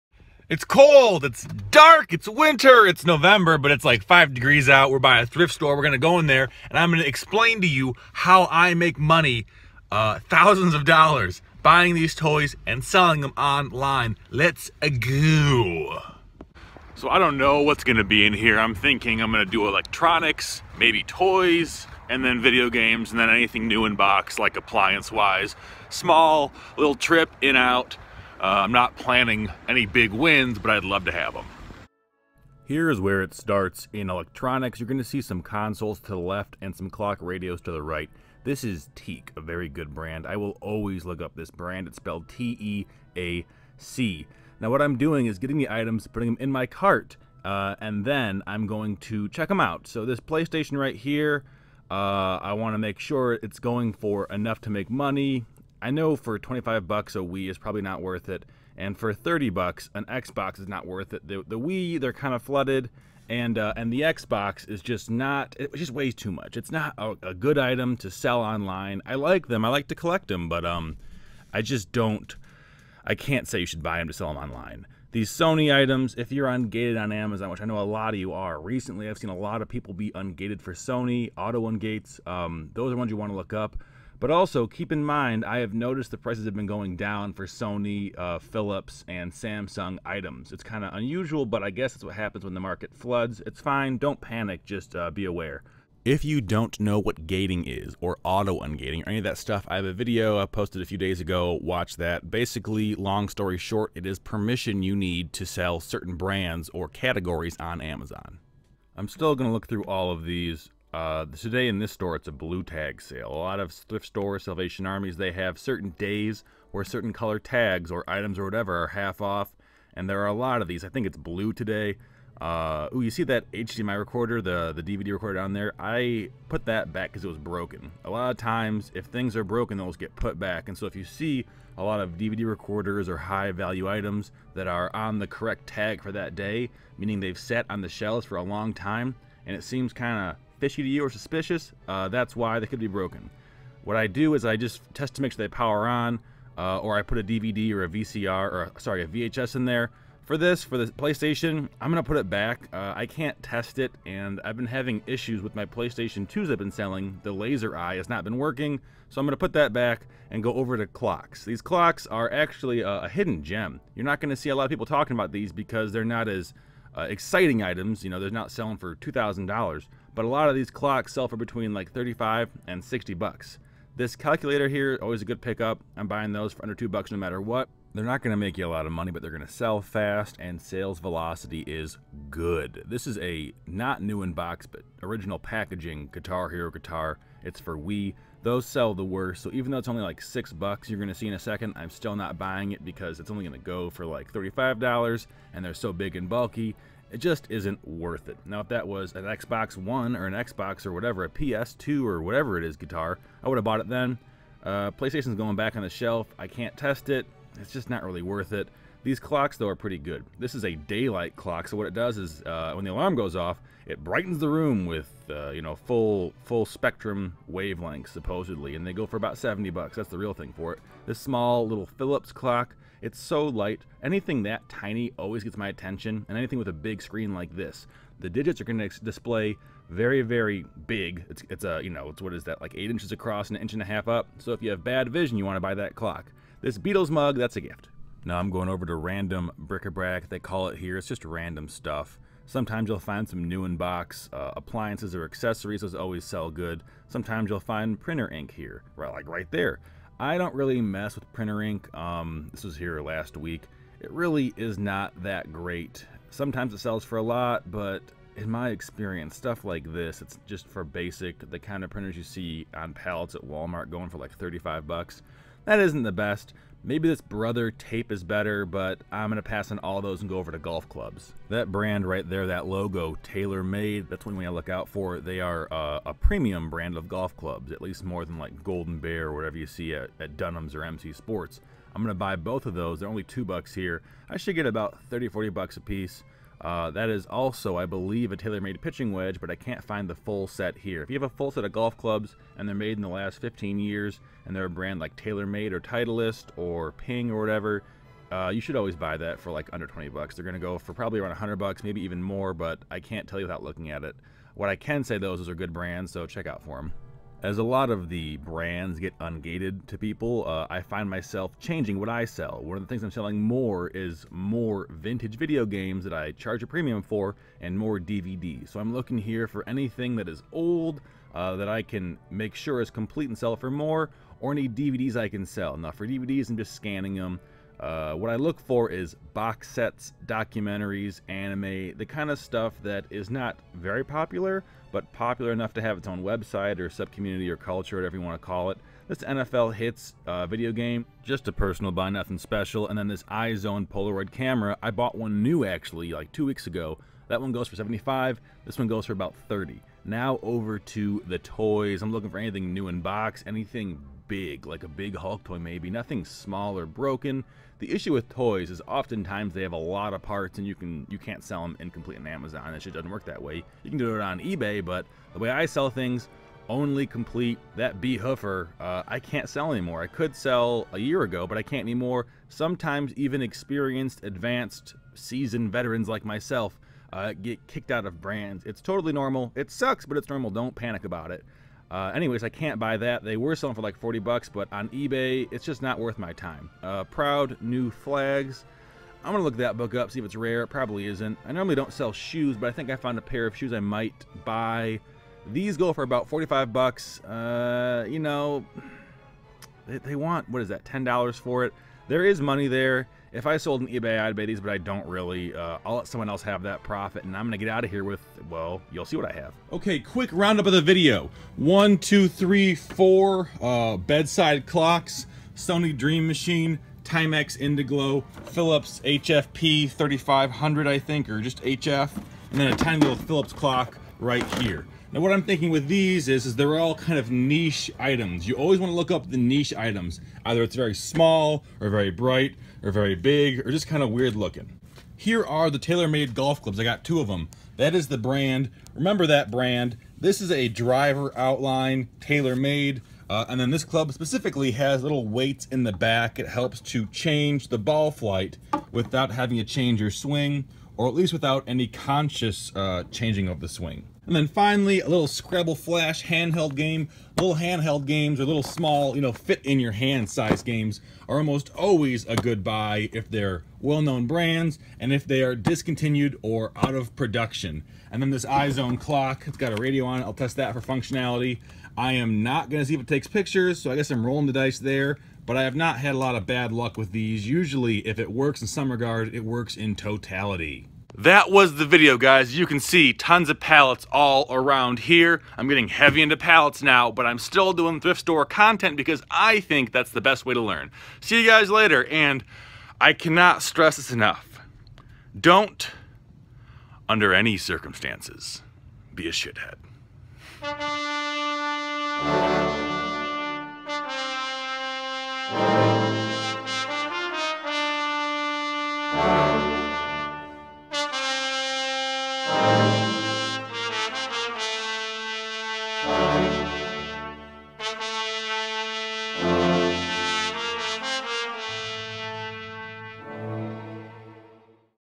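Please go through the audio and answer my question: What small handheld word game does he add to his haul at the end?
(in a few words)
Scrabble Flash.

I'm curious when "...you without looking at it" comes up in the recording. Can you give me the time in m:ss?
5:03.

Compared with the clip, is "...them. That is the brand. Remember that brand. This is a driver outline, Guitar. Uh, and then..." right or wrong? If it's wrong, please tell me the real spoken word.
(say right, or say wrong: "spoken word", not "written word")
wrong: "TaylorMade", not "Guitar".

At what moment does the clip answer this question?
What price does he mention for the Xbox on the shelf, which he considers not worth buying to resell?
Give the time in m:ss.
0:59.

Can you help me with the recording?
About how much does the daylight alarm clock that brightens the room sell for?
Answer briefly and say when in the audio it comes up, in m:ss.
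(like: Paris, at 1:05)
$70, at 3:39.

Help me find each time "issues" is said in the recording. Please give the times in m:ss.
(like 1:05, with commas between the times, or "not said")
2:35, 5:57.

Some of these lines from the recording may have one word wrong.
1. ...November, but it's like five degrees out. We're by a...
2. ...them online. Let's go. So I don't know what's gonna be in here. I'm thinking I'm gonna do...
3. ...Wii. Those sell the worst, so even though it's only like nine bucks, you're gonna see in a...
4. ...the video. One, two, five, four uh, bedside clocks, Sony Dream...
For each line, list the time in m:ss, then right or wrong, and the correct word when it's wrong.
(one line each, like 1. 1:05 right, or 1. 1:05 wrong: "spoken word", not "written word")
1. 0:03 right
2. 0:13 right
3. 3:07 wrong: "six", not "nine"
4. 6:50 wrong: "three", not "five".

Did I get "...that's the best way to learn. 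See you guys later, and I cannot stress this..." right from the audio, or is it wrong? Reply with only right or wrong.
right.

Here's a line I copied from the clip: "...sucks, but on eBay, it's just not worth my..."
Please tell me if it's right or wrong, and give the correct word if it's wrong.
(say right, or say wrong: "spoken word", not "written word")
wrong: "bucks", not "sucks".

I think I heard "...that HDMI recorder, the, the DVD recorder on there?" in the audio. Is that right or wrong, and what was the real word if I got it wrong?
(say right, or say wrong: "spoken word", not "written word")
right.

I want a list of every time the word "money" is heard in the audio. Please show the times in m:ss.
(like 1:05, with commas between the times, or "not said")
0:08, 0:54, 2:58, 6:42.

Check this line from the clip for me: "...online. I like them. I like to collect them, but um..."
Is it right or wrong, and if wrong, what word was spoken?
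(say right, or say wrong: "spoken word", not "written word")
right.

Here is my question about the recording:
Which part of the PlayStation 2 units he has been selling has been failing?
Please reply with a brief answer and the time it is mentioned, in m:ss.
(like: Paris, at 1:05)
The laser eye, at 2:37.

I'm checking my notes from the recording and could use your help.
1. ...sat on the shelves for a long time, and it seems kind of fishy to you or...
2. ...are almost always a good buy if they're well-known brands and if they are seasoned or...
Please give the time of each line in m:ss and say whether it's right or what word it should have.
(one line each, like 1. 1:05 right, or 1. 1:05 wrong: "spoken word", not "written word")
1. 2:17 right
2. 7:41 wrong: "discontinued", not "seasoned".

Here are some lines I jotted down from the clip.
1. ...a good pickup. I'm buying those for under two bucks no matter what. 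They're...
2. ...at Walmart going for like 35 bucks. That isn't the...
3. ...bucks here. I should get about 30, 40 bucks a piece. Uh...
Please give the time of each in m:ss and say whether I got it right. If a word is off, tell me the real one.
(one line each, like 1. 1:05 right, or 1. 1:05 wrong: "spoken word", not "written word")
1. 2:55 right
2. 4:23 right
3. 4:43 right.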